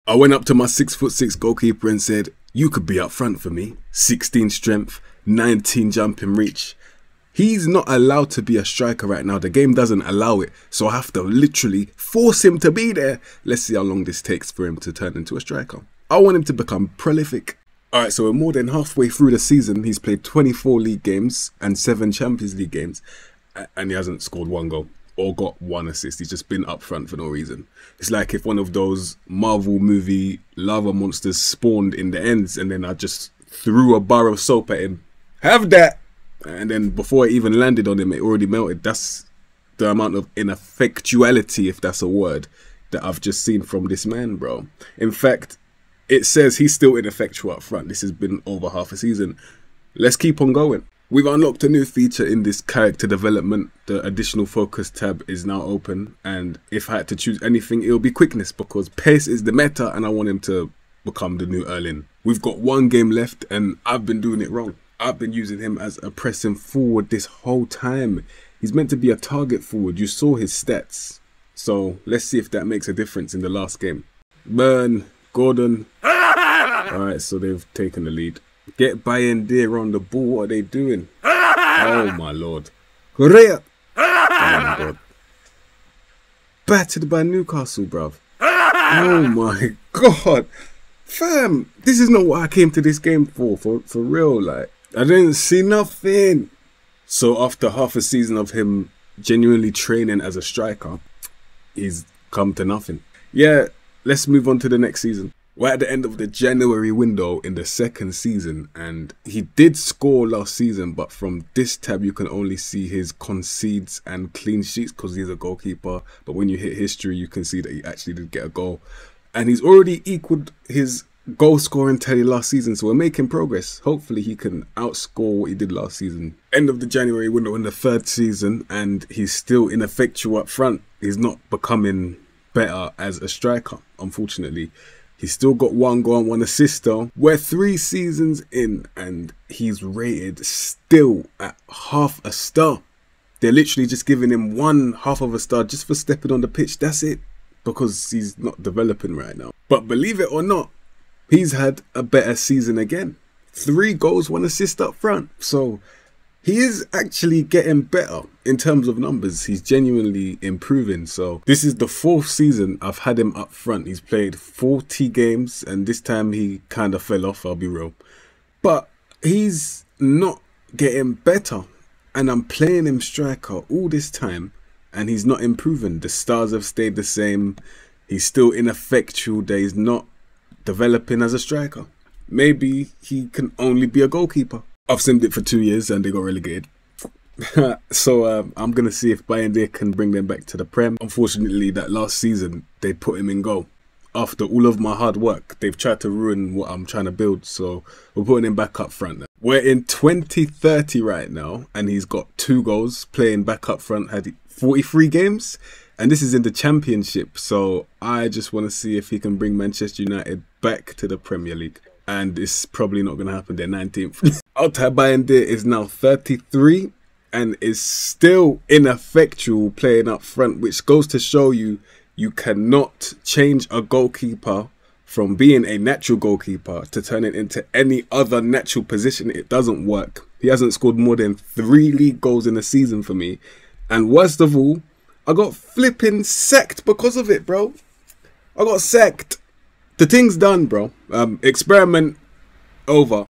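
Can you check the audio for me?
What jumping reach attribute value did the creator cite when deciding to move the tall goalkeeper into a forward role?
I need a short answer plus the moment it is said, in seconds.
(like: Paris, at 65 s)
19, at 5 s.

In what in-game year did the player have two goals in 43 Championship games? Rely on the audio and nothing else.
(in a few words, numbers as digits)
2030.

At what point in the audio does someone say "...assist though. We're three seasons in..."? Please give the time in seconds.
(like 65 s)
136 s.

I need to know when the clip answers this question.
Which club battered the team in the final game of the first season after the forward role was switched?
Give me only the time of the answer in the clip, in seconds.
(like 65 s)
87 s.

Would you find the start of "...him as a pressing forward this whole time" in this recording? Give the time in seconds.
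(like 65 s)
65 s.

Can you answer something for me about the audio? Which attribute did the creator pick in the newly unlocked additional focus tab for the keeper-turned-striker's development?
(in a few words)
Quickness.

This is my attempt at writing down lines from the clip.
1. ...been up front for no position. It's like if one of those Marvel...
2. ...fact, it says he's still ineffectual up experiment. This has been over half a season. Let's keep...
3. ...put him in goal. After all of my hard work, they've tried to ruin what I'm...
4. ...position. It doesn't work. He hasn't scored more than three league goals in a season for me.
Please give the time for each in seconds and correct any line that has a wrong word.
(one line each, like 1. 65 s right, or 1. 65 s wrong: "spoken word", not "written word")
1. 26 s wrong: "reason", not "position"
2. 45 s wrong: "front", not "experiment"
3. 192 s right
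4. 228 s right.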